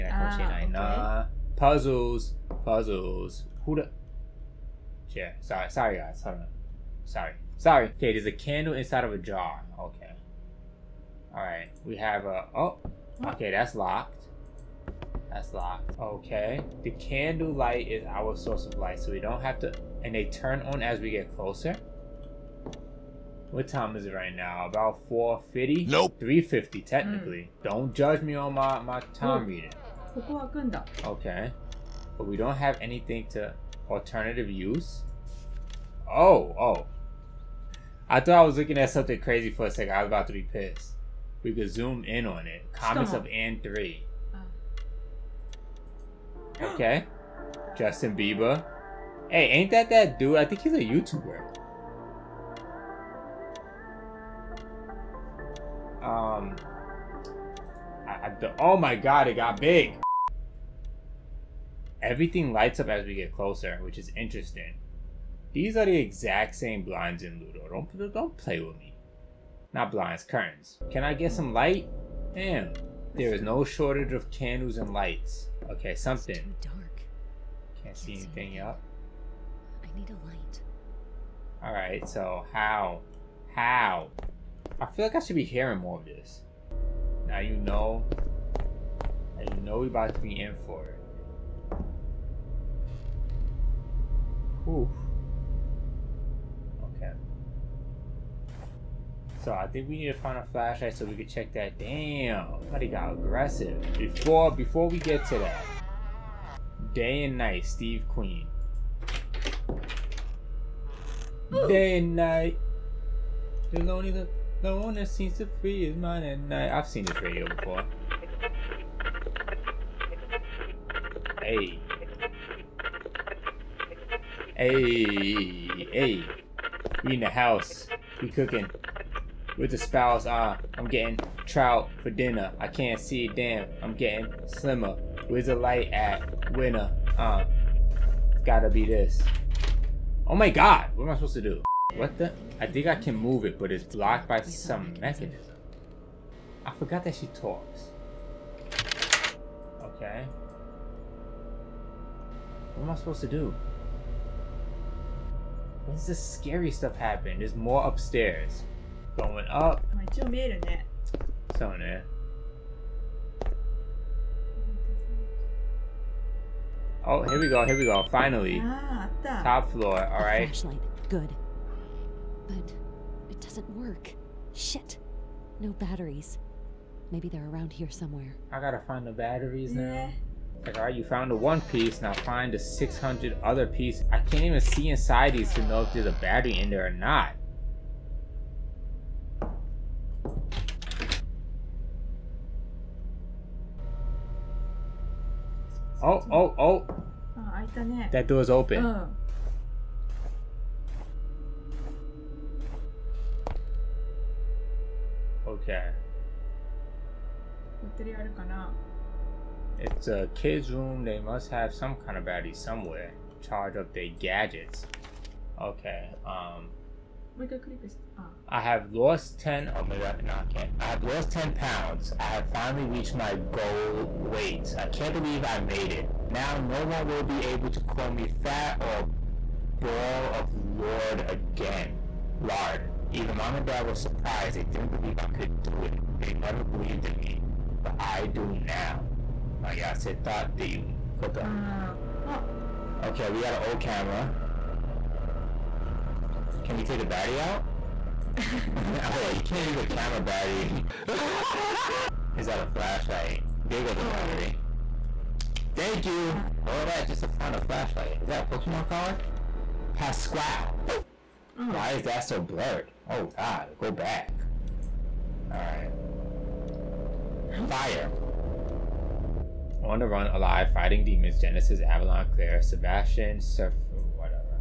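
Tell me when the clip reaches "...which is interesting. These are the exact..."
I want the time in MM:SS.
01:03.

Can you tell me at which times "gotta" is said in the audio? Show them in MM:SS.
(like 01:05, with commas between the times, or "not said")
02:18, 02:58.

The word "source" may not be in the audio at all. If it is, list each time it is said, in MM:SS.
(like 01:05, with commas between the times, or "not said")
00:18.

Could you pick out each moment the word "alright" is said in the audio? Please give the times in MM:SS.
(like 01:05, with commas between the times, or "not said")
01:21, 02:50, 03:00, 04:25.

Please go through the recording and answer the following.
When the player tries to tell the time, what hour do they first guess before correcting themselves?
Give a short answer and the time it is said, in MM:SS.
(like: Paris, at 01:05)
4.50, at 00:24.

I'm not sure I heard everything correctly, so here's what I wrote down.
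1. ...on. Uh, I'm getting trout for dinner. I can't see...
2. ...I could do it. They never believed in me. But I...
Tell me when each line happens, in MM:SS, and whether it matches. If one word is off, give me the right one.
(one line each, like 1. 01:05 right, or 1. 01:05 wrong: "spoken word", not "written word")
1. 02:10 right
2. 03:55 right.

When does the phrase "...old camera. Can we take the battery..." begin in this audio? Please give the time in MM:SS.
04:03.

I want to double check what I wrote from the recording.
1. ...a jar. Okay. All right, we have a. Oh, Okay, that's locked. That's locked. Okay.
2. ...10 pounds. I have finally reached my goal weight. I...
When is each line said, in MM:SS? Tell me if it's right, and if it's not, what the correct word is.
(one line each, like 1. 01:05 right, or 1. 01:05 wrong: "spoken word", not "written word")
1. 00:09 right
2. 03:41 right.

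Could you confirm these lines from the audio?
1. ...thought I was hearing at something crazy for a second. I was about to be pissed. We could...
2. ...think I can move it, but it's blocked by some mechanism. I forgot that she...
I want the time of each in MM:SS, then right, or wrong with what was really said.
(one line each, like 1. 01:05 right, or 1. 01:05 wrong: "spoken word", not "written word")
1. 00:38 wrong: "looking", not "hearing"
2. 02:22 right.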